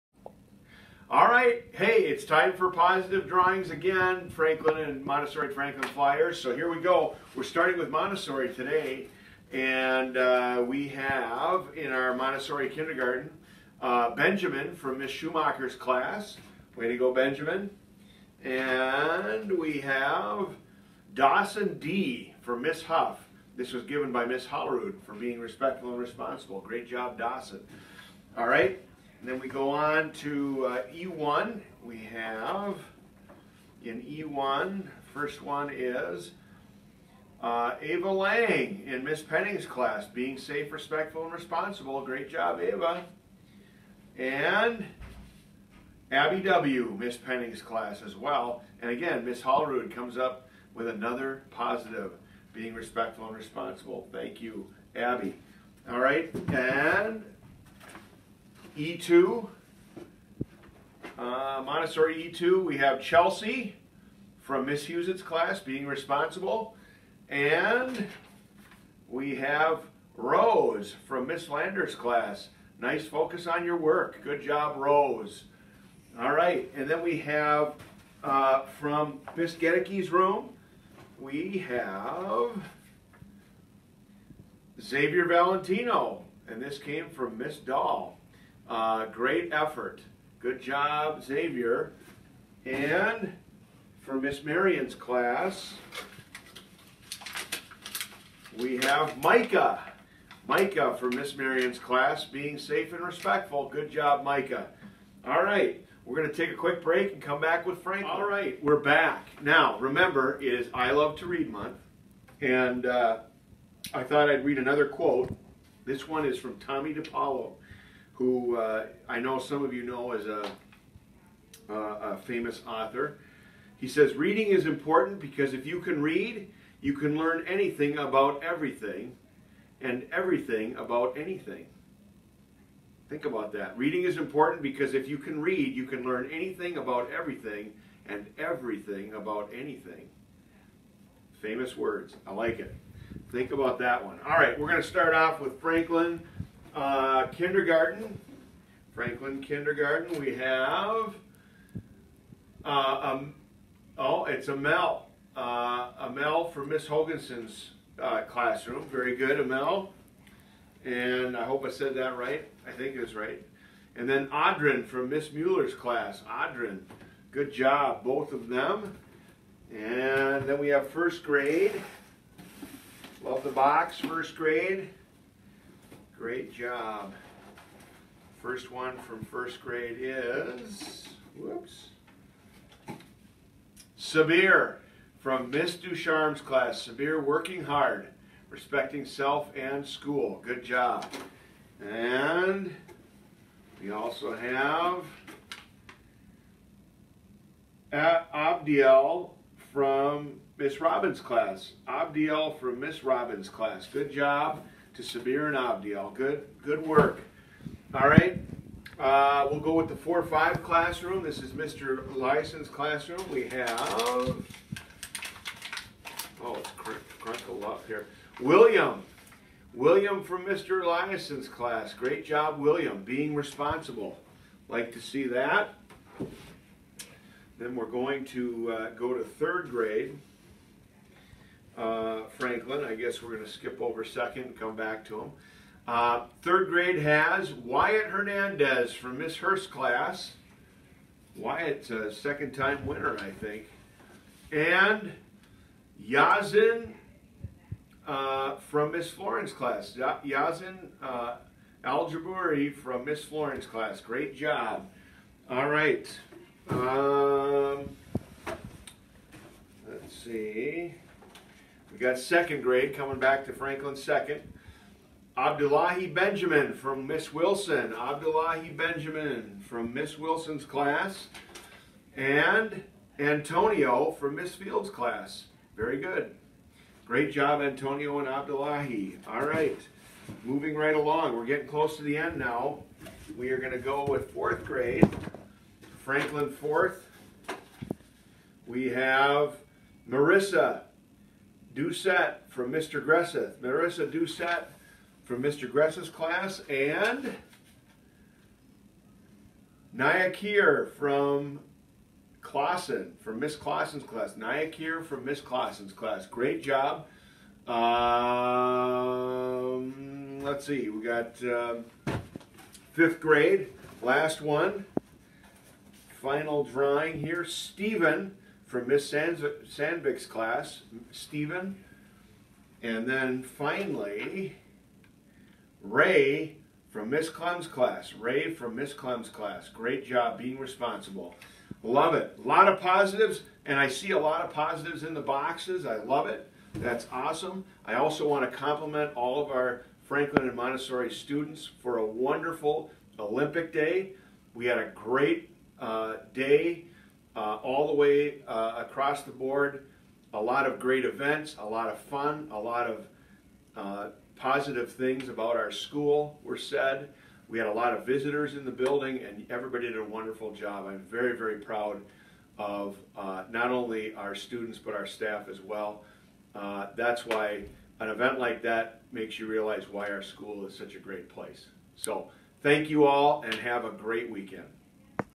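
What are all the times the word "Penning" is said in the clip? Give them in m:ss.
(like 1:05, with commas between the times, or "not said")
0:39, 0:47.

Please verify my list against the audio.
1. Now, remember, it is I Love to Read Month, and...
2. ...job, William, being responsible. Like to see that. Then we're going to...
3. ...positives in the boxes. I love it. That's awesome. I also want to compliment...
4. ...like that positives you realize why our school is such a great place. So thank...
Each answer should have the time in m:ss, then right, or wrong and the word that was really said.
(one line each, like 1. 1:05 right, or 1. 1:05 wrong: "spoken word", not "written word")
1. 1:49 right
2. 3:42 right
3. 5:34 right
4. 6:08 wrong: "makes", not "positives".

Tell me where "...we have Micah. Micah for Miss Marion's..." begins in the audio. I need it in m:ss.
1:38.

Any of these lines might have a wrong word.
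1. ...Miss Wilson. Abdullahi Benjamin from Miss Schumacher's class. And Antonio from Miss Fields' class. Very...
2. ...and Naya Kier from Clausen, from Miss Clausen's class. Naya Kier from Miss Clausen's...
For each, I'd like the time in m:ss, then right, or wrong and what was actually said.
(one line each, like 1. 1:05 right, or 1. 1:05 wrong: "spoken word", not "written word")
1. 4:27 wrong: "Wilson", not "Schumacher"
2. 4:56 right.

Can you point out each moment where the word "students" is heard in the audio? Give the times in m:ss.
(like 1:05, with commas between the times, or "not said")
5:41, 6:04.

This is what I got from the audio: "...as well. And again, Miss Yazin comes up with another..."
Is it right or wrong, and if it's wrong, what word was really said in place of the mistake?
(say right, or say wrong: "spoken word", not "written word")
wrong: "Hollerud", not "Yazin".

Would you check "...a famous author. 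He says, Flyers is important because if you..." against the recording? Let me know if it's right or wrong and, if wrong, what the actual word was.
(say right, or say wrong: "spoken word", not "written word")
wrong: "Reading", not "Flyers".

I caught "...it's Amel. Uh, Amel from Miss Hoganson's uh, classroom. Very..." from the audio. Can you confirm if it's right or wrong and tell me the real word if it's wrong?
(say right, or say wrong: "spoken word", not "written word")
right.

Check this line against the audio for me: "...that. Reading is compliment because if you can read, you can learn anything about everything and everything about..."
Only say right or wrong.
wrong.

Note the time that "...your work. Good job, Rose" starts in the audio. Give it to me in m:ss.
1:13.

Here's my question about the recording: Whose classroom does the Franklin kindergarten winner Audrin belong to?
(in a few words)
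Miss Mueller.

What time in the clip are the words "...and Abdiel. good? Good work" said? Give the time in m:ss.
3:25.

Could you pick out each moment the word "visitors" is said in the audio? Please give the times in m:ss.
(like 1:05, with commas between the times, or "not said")
5:58.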